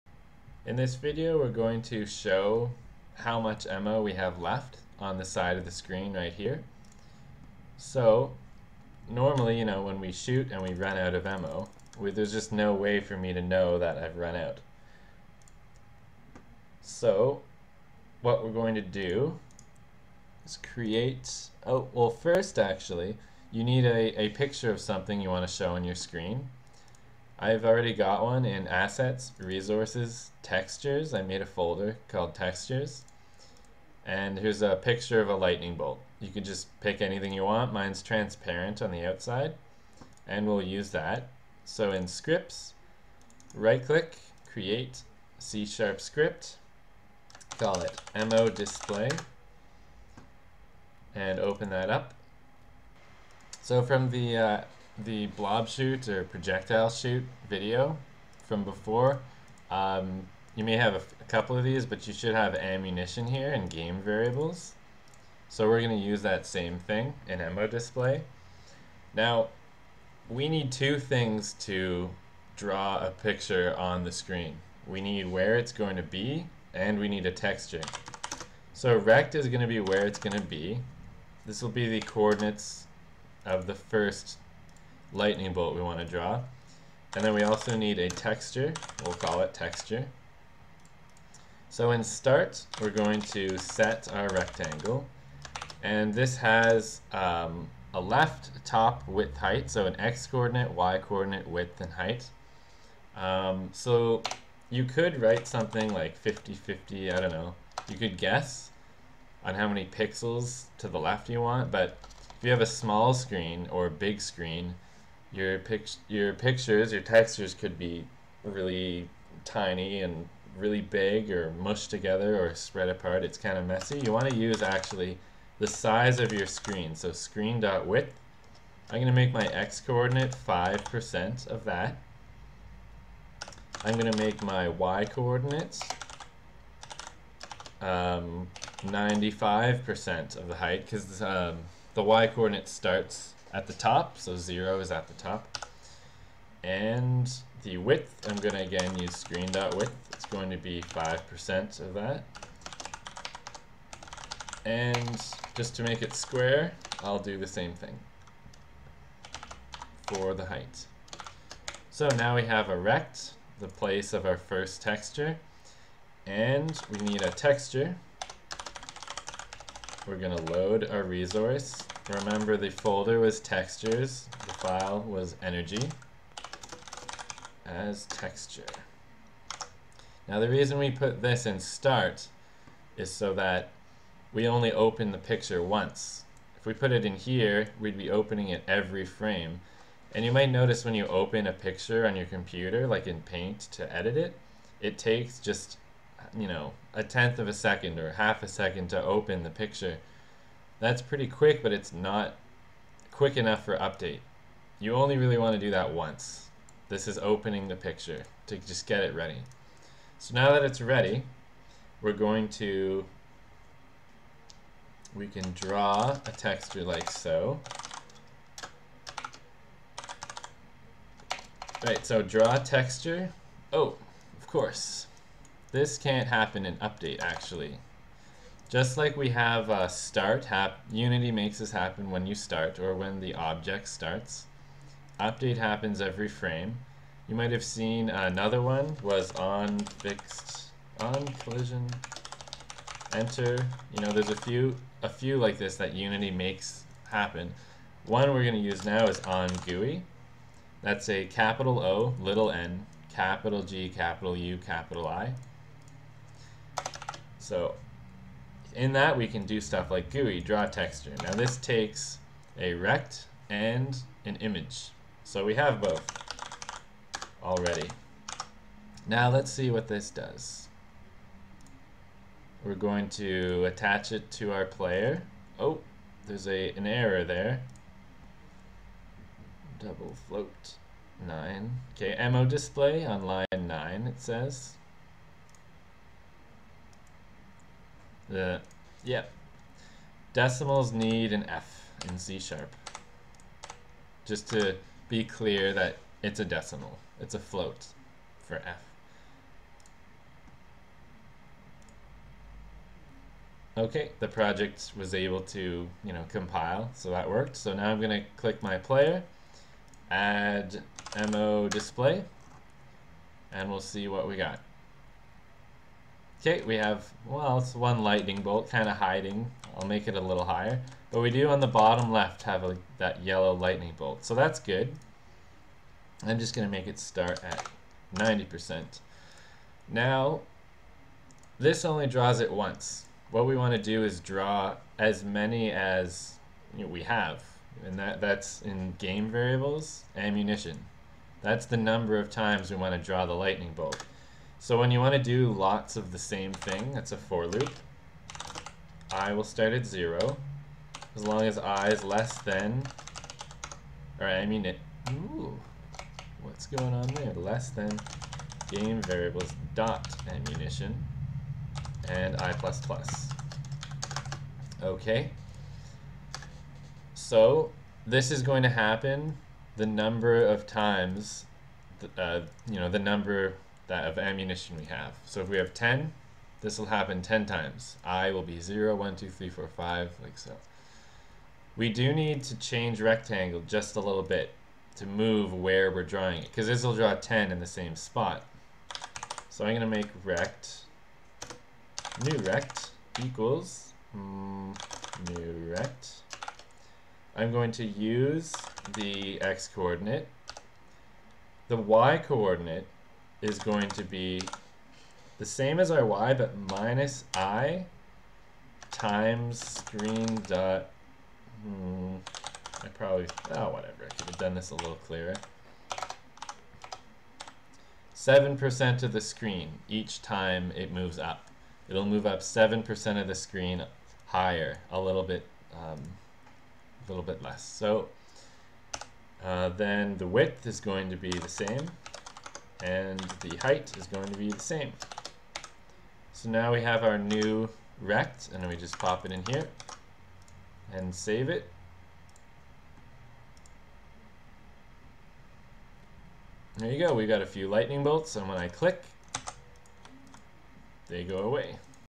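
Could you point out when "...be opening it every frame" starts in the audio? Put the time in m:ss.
3:07.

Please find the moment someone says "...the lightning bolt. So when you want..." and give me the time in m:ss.
5:43.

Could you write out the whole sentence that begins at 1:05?
So we're going to use that same thing in ammo display.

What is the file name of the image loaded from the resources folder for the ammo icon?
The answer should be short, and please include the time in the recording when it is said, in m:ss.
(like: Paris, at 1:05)
energy, at 2:55.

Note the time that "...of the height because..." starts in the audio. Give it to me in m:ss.
2:20.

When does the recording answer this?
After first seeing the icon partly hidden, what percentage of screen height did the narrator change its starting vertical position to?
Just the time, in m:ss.
5:28.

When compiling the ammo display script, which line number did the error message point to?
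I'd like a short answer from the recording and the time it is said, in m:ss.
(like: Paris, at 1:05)
9, at 4:43.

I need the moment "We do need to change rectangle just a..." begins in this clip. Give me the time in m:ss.
6:21.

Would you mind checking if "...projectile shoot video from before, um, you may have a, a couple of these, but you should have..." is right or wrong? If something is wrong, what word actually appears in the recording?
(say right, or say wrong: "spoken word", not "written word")
right.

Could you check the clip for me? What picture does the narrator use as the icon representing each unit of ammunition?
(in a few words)
a lightning bolt.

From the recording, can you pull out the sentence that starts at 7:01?
It'll move up 7% of the screen higher, a little bit, um, a little bit less.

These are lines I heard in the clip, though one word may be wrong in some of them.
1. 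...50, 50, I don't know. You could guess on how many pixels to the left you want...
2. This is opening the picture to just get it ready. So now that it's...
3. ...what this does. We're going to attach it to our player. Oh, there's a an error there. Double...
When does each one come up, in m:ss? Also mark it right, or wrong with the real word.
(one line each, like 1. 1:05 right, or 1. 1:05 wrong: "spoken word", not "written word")
1. 1:46 right
2. 3:26 right
3. 4:29 right.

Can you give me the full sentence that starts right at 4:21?
Now this takes a rect and an image.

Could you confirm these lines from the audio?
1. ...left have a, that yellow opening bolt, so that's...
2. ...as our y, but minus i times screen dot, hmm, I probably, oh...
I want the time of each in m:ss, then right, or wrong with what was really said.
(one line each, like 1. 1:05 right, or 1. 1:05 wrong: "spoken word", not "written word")
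1. 5:22 wrong: "lightning", not "opening"
2. 6:45 right.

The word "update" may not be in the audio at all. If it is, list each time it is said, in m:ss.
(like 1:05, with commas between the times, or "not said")
3:23, 3:46, 3:55.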